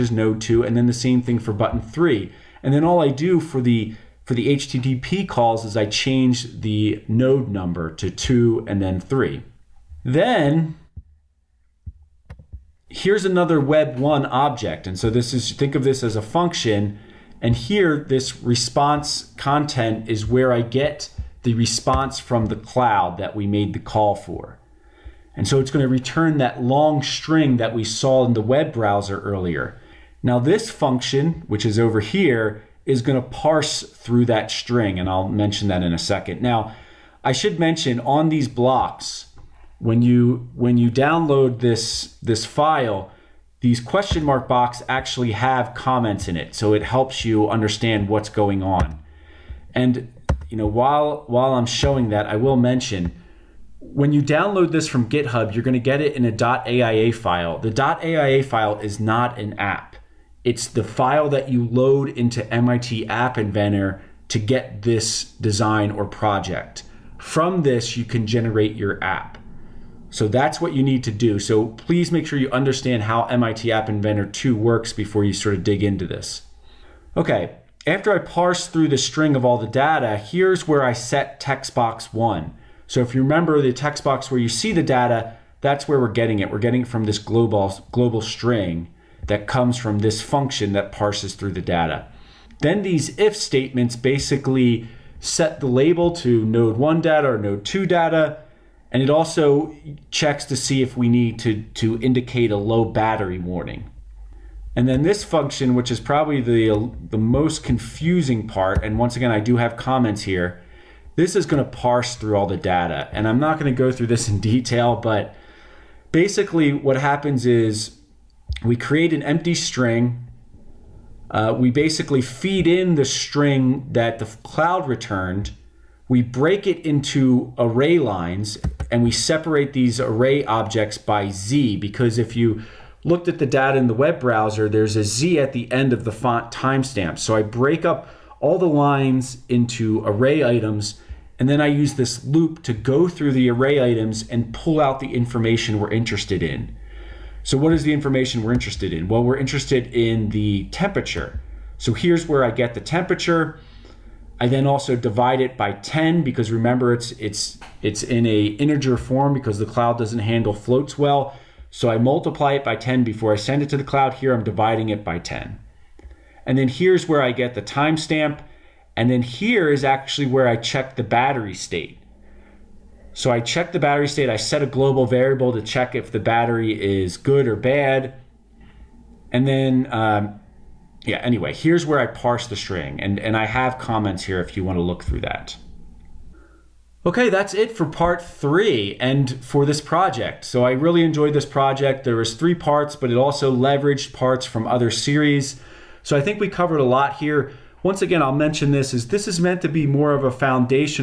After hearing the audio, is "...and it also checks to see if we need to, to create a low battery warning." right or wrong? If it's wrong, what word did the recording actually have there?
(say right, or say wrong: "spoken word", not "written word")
wrong: "indicate", not "create".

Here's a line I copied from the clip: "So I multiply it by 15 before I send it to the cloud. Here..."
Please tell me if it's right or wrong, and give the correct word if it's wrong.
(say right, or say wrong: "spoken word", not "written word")
wrong: "10", not "15".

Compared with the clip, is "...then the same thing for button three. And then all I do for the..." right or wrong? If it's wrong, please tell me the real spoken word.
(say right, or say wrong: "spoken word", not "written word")
right.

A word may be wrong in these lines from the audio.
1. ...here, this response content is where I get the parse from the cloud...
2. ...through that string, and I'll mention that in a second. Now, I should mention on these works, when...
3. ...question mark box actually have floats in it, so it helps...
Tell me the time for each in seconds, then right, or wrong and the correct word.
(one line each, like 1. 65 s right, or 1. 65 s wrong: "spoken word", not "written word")
1. 17 s wrong: "response", not "parse"
2. 33 s wrong: "blocks", not "works"
3. 43 s wrong: "comments", not "floats".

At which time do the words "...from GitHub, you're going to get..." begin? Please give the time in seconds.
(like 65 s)
54 s.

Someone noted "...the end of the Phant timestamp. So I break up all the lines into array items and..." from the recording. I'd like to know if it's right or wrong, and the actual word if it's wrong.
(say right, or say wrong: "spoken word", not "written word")
right.